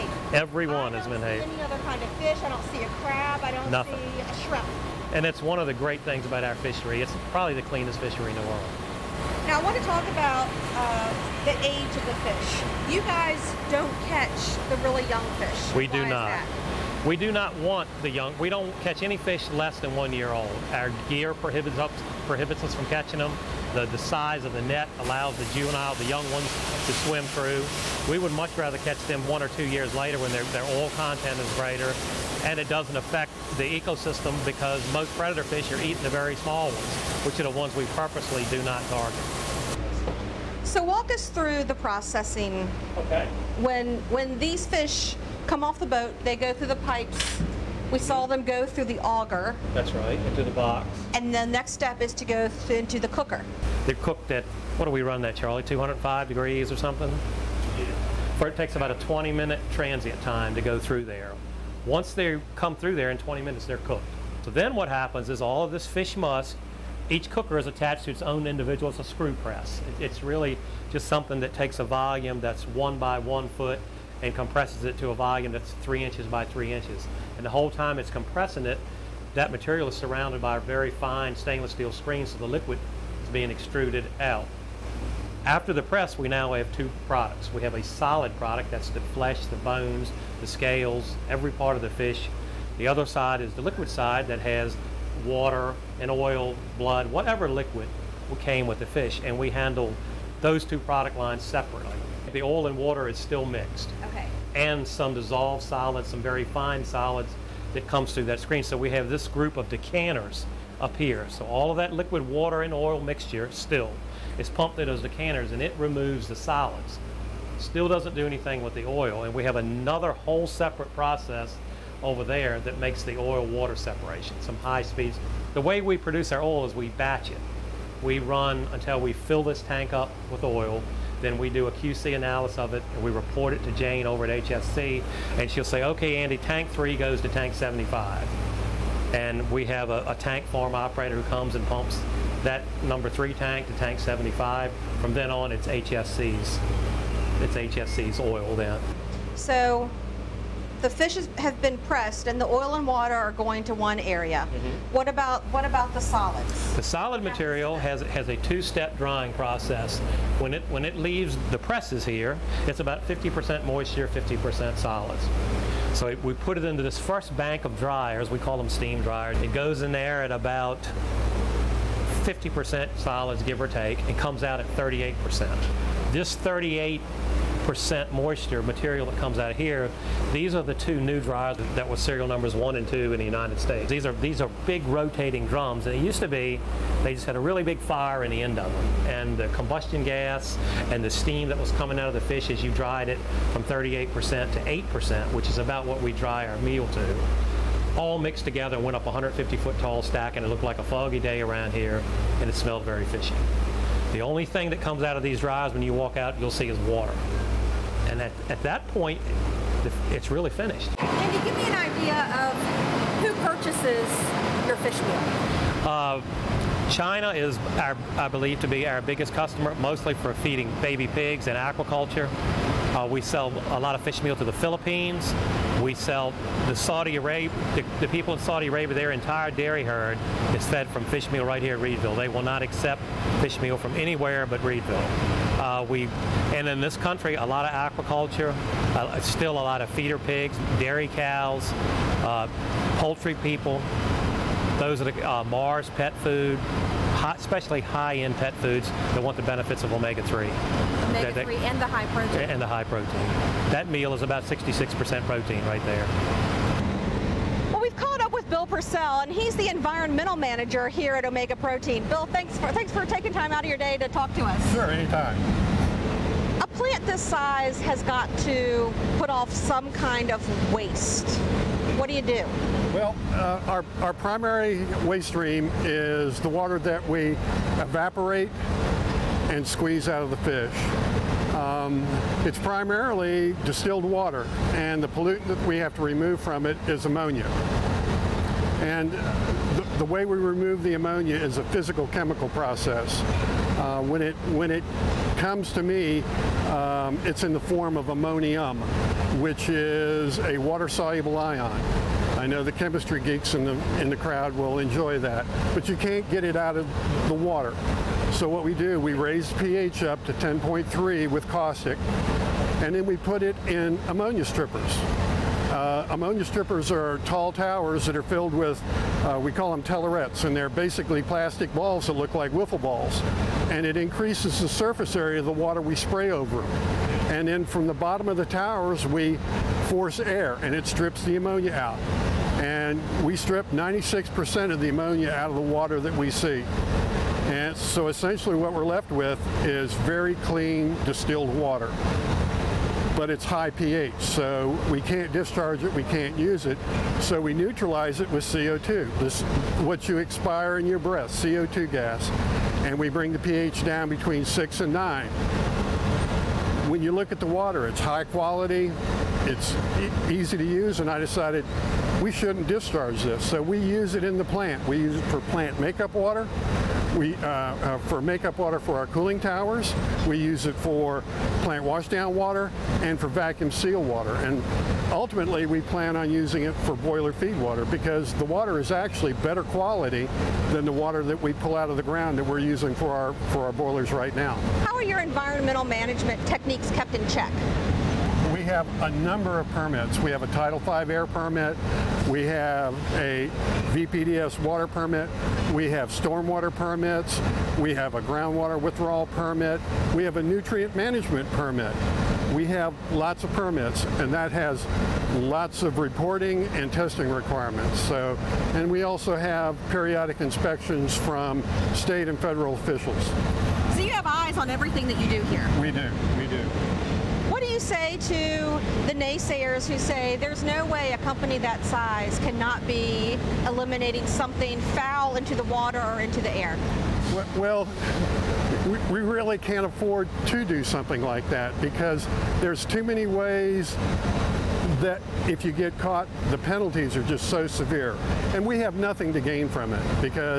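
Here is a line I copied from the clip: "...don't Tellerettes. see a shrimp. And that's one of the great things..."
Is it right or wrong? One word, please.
wrong.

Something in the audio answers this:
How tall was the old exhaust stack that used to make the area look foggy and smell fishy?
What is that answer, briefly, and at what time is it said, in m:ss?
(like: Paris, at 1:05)
150 feet, at 3:19.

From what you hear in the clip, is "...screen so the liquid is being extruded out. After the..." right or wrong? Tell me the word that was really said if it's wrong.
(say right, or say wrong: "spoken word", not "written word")
right.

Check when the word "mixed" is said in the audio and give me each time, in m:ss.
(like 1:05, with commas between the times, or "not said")
1:43, 3:18.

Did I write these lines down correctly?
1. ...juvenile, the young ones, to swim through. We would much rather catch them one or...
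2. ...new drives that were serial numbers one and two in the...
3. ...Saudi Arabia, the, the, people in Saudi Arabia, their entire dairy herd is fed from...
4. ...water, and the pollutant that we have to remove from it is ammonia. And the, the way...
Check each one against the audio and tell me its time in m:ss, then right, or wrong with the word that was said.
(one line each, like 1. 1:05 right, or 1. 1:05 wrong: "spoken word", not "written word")
1. 0:25 right
2. 3:00 right
3. 3:46 right
4. 4:44 right.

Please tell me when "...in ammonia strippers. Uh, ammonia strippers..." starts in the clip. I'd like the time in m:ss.
5:13.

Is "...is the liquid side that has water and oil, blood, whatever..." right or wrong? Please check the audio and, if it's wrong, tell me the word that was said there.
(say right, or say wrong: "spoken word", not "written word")
right.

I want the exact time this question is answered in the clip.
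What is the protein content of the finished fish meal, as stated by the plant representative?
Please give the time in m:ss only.
4:14.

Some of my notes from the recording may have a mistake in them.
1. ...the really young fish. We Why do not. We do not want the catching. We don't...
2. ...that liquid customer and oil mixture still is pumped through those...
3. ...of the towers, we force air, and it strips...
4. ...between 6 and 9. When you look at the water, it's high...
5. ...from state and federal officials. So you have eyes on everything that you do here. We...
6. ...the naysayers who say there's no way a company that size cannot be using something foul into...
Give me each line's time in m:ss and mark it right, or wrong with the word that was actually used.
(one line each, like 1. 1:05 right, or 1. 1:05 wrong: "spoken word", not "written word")
1. 0:14 wrong: "young", not "catching"
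2. 1:51 wrong: "water", not "customer"
3. 5:28 right
4. 5:54 right
5. 6:51 right
6. 6:59 wrong: "eliminating", not "using".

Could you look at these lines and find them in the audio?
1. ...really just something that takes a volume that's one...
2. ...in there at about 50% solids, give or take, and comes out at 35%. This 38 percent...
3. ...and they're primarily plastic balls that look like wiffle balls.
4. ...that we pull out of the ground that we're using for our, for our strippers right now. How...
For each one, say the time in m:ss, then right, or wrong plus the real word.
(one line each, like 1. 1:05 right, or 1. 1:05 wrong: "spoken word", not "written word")
1. 1:10 right
2. 2:49 wrong: "38", not "35"
3. 5:20 wrong: "basically", not "primarily"
4. 6:21 wrong: "boilers", not "strippers".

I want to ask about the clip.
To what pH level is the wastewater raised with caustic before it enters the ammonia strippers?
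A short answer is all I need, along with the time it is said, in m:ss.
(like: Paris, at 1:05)
10.3, at 5:10.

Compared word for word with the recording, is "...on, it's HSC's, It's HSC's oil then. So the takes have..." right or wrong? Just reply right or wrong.
wrong.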